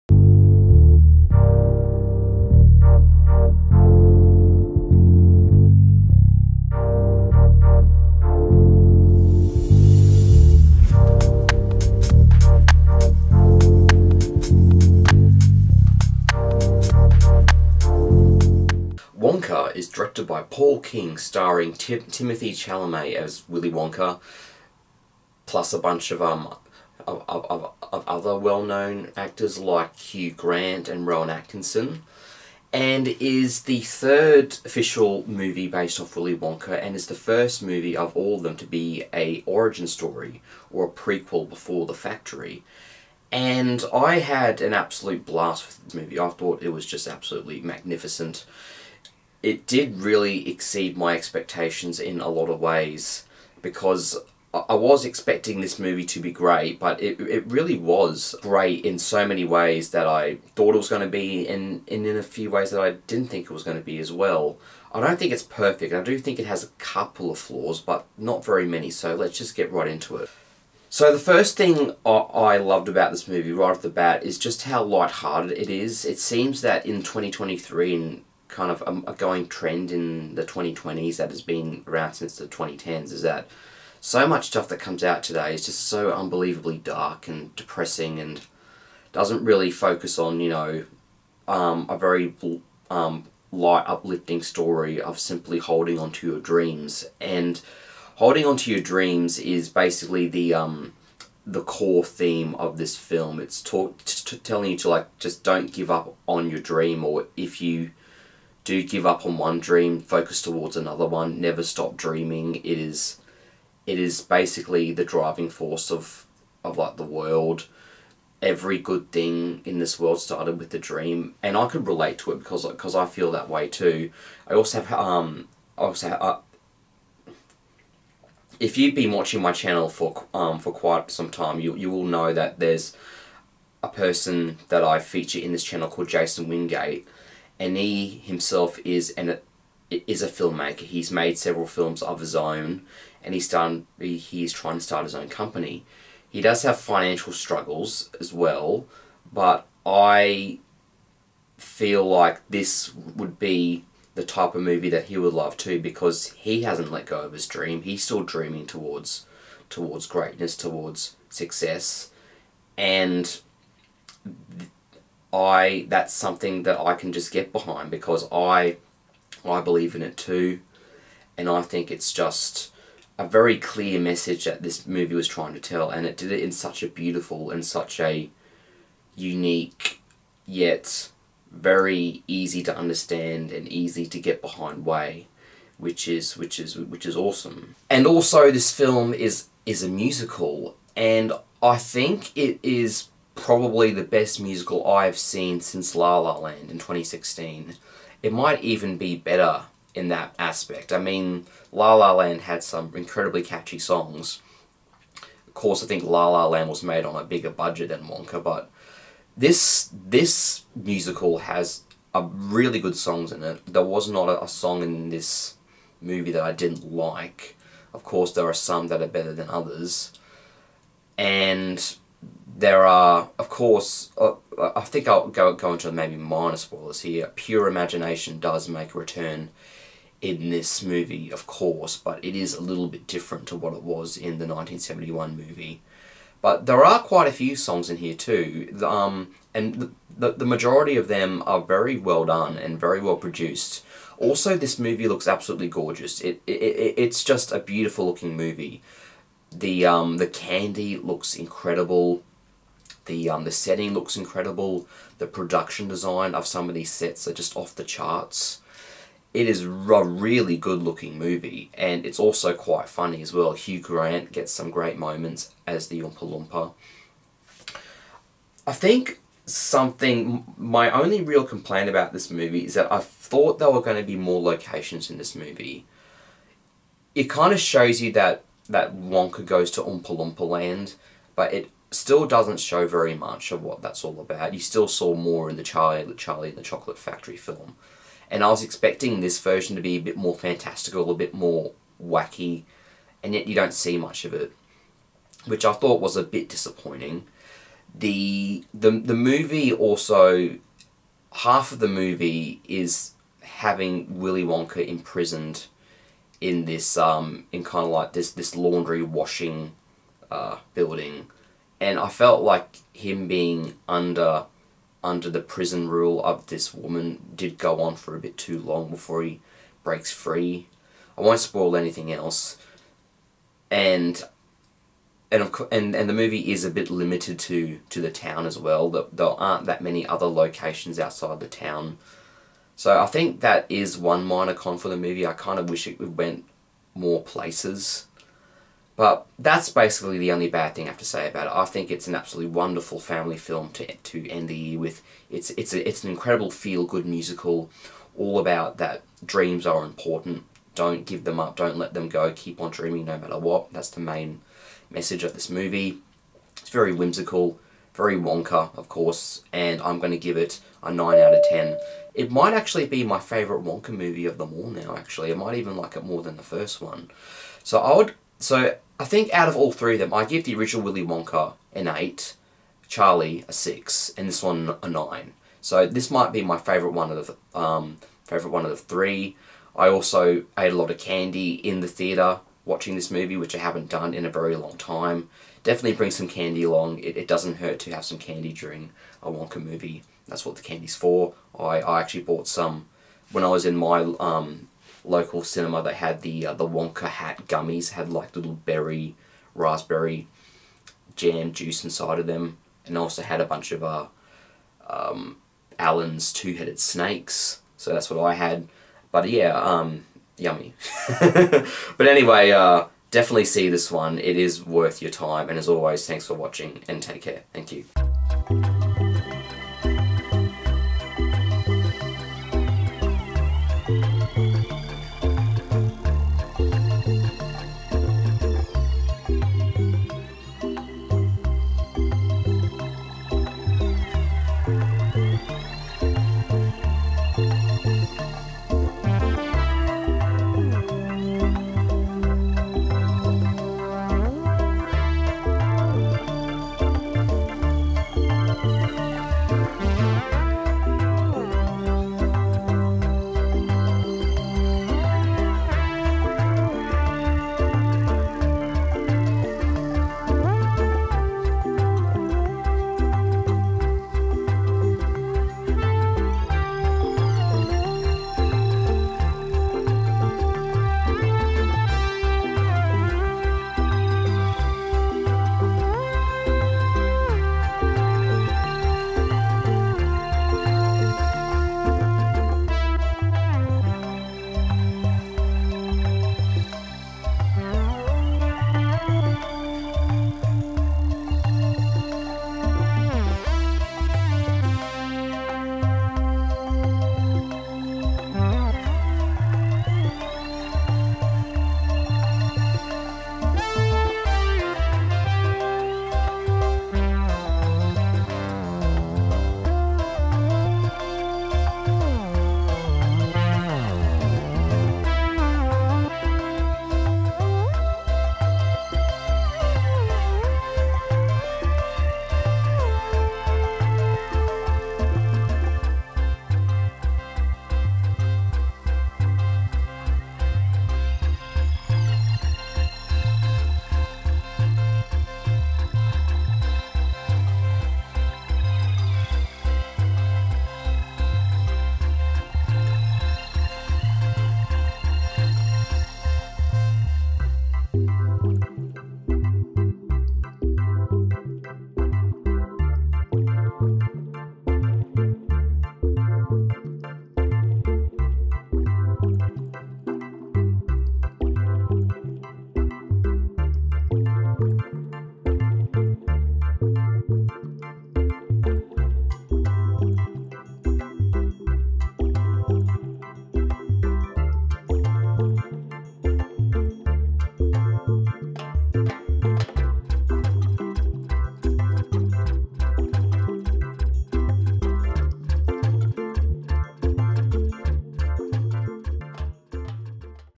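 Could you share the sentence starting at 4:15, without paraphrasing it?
The production design of some of these sets are just off the charts.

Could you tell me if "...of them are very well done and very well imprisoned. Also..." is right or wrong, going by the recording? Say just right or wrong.
wrong.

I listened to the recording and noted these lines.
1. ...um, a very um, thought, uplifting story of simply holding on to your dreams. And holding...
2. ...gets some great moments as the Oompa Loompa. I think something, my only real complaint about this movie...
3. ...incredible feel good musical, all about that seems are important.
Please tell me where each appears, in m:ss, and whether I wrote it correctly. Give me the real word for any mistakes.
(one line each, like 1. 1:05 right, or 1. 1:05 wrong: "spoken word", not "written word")
1. 1:31 wrong: "light", not "thought"
2. 4:24 right
3. 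5:46 wrong: "dreams", not "seems".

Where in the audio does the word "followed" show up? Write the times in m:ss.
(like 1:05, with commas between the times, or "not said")
not said.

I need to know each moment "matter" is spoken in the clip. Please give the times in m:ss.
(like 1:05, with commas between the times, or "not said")
5:53.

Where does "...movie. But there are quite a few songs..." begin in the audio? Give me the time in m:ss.
3:55.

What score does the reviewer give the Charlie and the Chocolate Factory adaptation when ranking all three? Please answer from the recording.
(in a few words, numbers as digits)
6.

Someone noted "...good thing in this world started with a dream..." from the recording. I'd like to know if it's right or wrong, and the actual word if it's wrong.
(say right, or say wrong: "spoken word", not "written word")
right.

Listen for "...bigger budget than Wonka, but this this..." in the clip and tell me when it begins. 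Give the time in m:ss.
3:27.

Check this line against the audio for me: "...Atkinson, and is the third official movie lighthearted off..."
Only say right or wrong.
wrong.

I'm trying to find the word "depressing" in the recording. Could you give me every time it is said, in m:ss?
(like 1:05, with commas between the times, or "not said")
1:27.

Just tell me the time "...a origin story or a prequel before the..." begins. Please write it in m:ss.
0:39.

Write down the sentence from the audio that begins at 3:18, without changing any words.
It might even be better in that aspect.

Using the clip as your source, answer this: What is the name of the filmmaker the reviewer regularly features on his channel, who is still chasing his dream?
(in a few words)
Jason Wingate.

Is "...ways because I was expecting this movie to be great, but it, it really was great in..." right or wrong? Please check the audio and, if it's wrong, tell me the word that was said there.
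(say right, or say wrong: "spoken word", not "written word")
right.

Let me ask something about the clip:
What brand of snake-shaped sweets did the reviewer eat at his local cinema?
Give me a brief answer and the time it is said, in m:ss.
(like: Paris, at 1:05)
Allen's, at 6:45.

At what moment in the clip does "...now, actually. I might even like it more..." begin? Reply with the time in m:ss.
6:04.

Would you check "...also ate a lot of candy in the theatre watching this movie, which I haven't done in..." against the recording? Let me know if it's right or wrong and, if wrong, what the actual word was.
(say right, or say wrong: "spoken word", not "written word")
right.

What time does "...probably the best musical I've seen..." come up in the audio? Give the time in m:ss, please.
3:13.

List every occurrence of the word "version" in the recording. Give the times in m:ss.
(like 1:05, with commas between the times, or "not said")
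4:49.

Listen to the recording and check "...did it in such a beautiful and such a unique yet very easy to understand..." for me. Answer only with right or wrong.
right.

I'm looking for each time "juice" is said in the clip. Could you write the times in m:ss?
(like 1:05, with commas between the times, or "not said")
6:41.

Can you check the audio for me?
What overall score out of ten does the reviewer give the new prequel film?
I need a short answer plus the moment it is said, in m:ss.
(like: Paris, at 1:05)
9, at 6:00.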